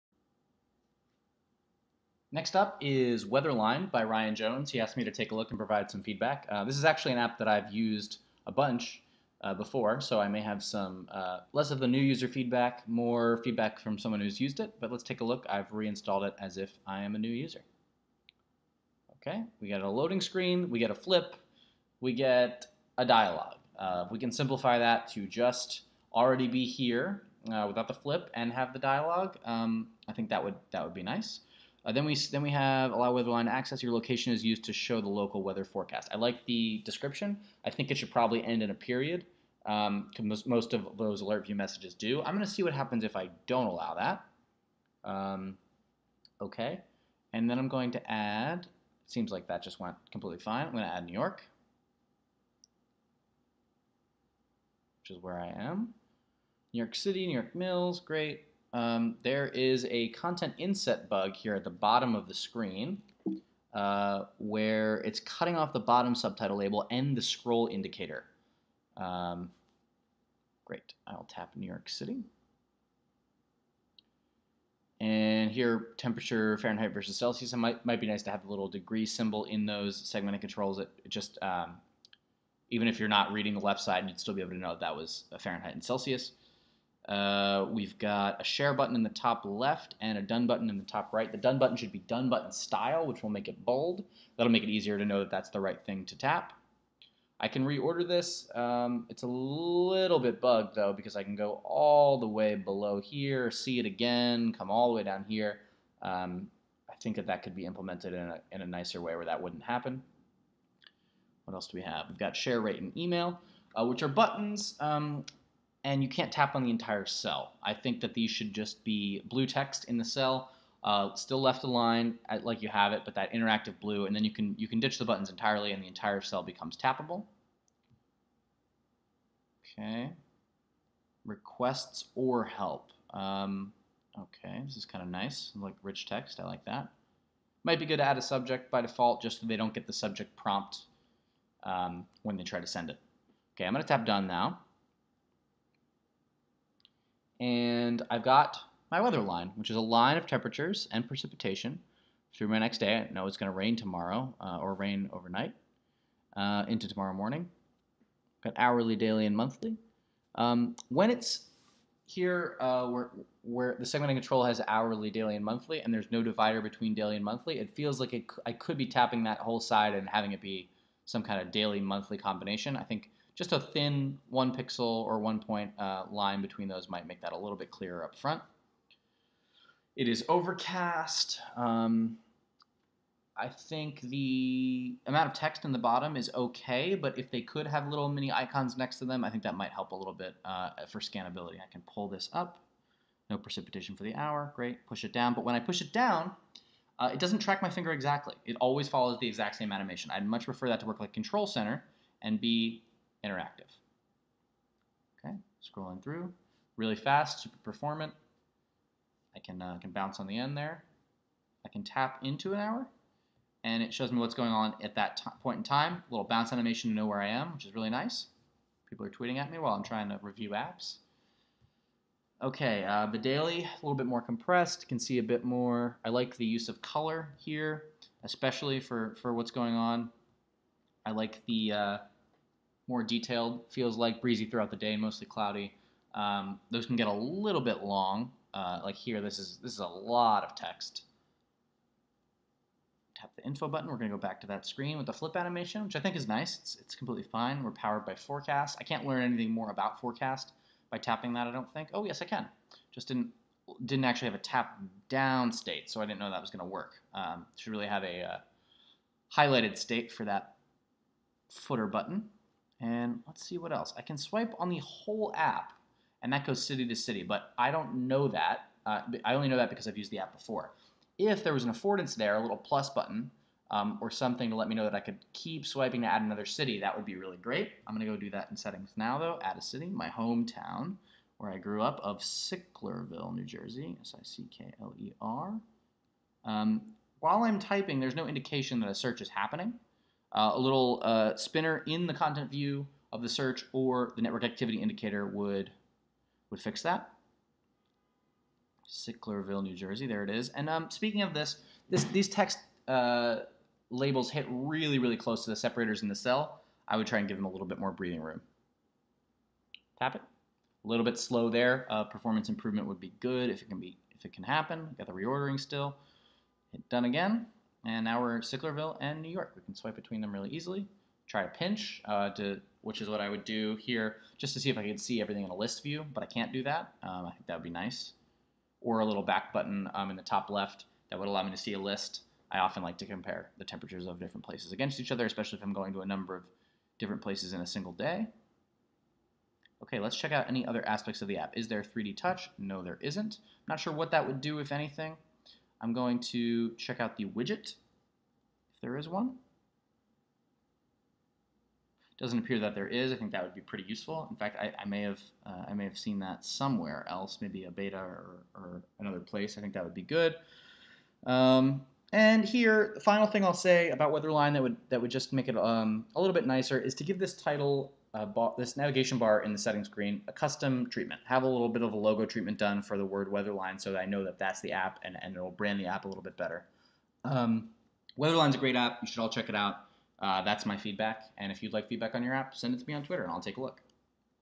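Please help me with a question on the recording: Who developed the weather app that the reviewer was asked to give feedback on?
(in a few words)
Ryan Jones.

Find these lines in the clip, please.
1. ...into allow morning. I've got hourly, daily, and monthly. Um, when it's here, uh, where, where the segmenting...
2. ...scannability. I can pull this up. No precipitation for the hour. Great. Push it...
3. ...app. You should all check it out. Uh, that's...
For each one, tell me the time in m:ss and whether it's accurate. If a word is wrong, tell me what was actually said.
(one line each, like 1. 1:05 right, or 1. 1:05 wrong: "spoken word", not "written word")
1. 2:36 wrong: "tomorrow", not "allow"
2. 3:10 right
3. 6:18 right.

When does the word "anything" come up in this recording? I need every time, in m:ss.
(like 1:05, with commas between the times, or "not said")
4:09, 5:44.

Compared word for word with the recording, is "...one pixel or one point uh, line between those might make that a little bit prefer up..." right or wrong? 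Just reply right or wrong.
wrong.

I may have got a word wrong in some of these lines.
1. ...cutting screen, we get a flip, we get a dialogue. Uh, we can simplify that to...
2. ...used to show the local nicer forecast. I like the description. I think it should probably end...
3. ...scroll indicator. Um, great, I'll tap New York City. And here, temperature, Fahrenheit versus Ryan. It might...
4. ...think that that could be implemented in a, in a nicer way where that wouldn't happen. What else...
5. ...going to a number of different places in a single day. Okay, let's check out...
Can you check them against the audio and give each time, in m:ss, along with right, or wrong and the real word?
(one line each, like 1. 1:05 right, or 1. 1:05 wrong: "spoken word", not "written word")
1. 0:19 wrong: "loading", not "cutting"
2. 0:34 wrong: "weather", not "nicer"
3. 1:07 wrong: "Celsius", not "Ryan"
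4. 1:47 right
5. 5:35 right.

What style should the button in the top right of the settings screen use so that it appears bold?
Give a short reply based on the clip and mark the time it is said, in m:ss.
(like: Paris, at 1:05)
done button style, at 1:31.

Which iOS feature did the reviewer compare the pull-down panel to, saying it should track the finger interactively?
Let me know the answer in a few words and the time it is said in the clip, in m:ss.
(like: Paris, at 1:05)
Control Center, at 3:21.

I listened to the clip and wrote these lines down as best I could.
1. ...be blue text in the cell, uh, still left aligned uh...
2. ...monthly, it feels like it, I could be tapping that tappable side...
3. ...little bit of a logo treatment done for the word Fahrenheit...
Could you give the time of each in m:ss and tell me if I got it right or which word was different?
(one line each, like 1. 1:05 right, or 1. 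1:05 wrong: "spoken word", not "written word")
1. 1:58 right
2. 2:47 wrong: "whole", not "tappable"
3. 6:11 wrong: "Weatherline", not "Fahrenheit".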